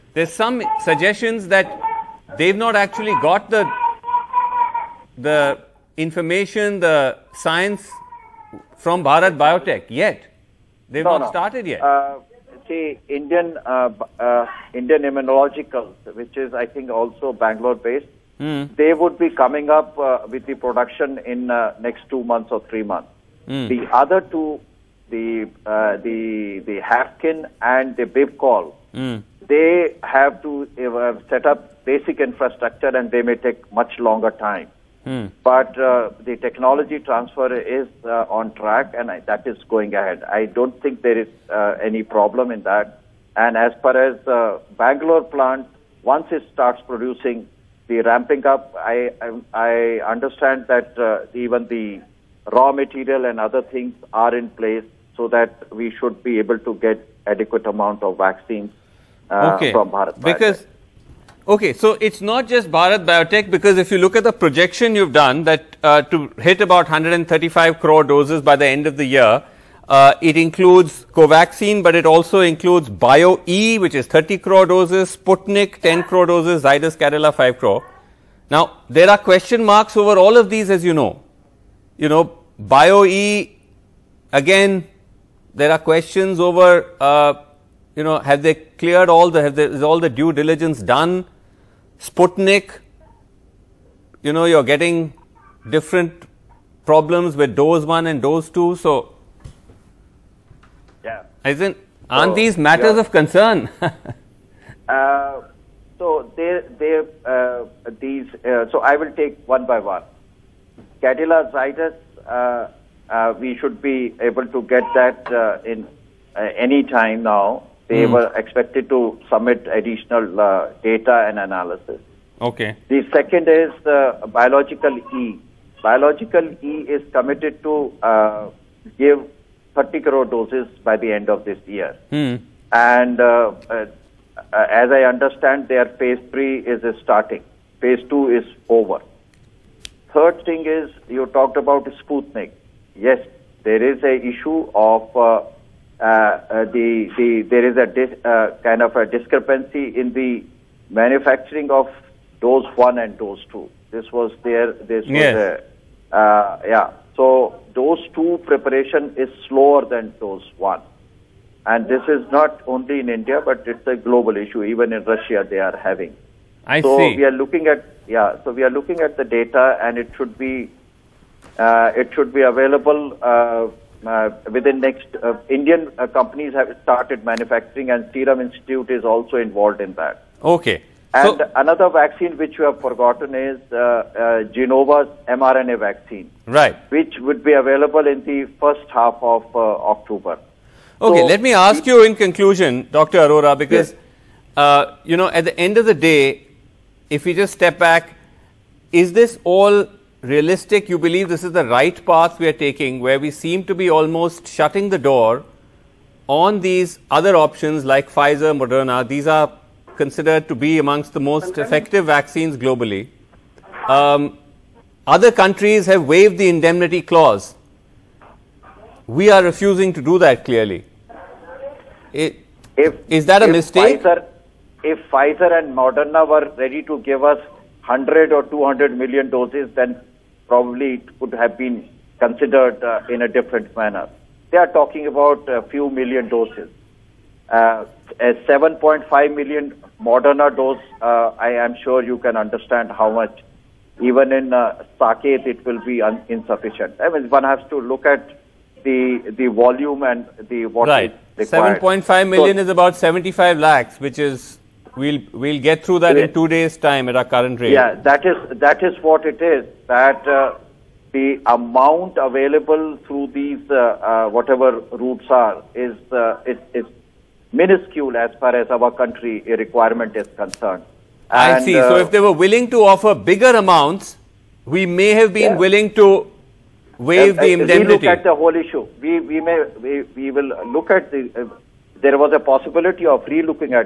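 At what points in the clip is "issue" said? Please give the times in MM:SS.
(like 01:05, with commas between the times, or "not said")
02:24, 02:44, 04:38.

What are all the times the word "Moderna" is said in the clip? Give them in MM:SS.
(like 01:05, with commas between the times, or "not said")
03:28, 03:45, 04:00.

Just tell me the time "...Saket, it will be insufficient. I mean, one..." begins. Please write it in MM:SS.
04:04.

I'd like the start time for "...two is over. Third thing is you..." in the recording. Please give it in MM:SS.
02:18.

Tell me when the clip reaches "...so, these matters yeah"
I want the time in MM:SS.
01:42.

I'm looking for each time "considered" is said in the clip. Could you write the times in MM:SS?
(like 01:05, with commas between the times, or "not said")
03:29, 03:52.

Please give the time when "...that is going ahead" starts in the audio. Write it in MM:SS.
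00:39.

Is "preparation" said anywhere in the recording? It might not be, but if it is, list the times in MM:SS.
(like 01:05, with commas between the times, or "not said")
02:38.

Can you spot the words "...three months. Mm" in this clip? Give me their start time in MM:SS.
00:22.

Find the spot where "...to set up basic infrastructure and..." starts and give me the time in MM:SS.
00:30.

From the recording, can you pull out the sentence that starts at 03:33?
Um, other countries have waived the indemnity clause.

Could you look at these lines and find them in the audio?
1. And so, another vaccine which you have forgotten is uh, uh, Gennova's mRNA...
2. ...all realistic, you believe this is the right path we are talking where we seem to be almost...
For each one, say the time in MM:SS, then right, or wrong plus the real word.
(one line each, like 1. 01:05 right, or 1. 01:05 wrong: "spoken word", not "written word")
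1. 03:01 right
2. 03:19 wrong: "taking", not "talking".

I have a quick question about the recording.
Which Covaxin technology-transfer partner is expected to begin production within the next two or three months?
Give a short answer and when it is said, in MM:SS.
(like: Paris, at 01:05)
Indian Immunologicals, at 00:14.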